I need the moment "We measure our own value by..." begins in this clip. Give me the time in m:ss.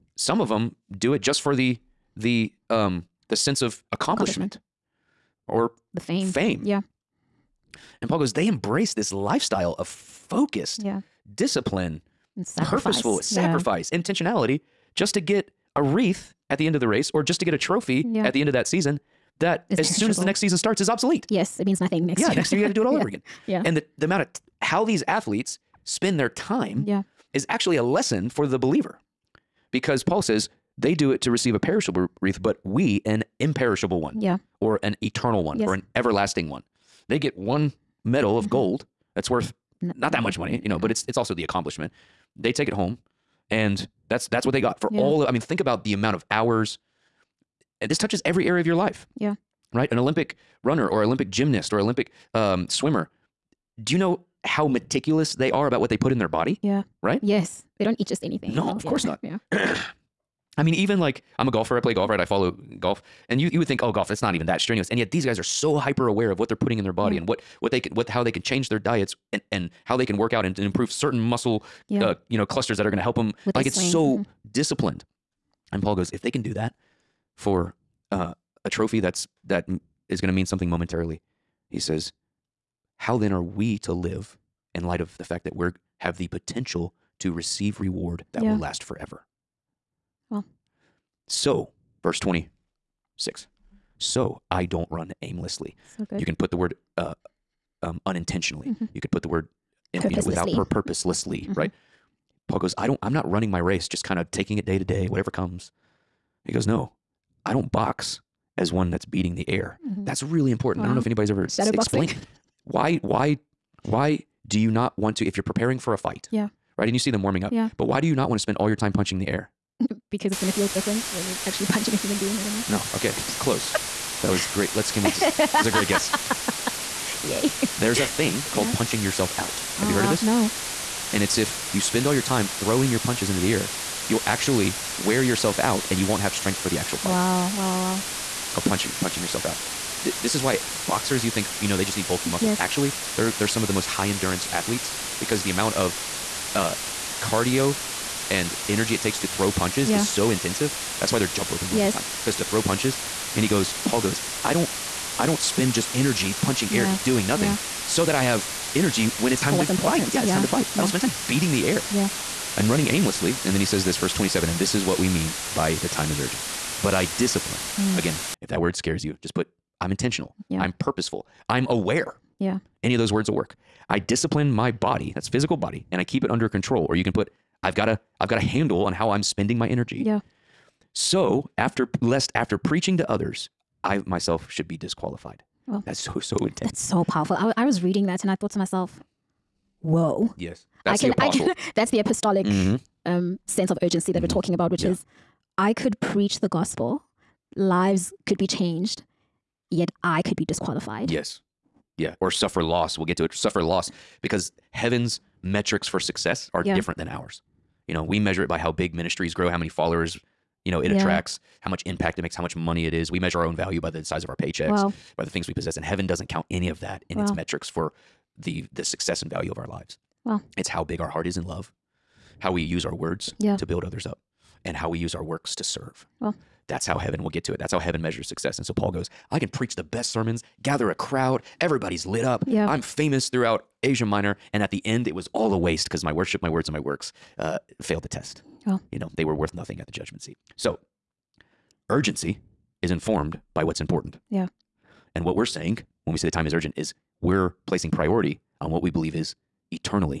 3:33.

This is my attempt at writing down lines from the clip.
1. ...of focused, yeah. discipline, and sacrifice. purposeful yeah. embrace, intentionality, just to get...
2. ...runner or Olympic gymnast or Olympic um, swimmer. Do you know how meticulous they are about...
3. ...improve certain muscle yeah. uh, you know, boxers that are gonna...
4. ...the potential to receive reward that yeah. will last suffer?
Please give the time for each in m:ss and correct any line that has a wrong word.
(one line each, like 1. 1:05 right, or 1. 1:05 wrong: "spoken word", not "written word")
1. 0:09 wrong: "sacrifice", not "embrace"
2. 0:50 right
3. 1:10 wrong: "clusters", not "boxers"
4. 1:26 wrong: "forever", not "suffer".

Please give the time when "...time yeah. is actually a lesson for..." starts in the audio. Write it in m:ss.
0:26.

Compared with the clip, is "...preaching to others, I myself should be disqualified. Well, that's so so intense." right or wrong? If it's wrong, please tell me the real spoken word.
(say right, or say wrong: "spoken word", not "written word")
right.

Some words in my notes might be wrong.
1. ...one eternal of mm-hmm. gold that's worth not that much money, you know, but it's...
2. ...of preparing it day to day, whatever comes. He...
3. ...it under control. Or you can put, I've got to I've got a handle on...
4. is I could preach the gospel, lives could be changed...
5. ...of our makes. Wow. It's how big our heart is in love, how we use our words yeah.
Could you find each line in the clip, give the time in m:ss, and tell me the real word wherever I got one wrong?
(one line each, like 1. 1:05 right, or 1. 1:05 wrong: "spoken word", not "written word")
1. 0:37 wrong: "medal", not "eternal"
2. 1:44 wrong: "taking", not "preparing"
3. 2:56 right
4. 3:14 right
5. 3:39 wrong: "lives", not "makes".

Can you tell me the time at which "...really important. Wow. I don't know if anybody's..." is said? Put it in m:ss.
1:50.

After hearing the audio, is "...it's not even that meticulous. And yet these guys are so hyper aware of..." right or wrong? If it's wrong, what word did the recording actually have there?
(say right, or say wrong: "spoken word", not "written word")
wrong: "strenuous", not "meticulous".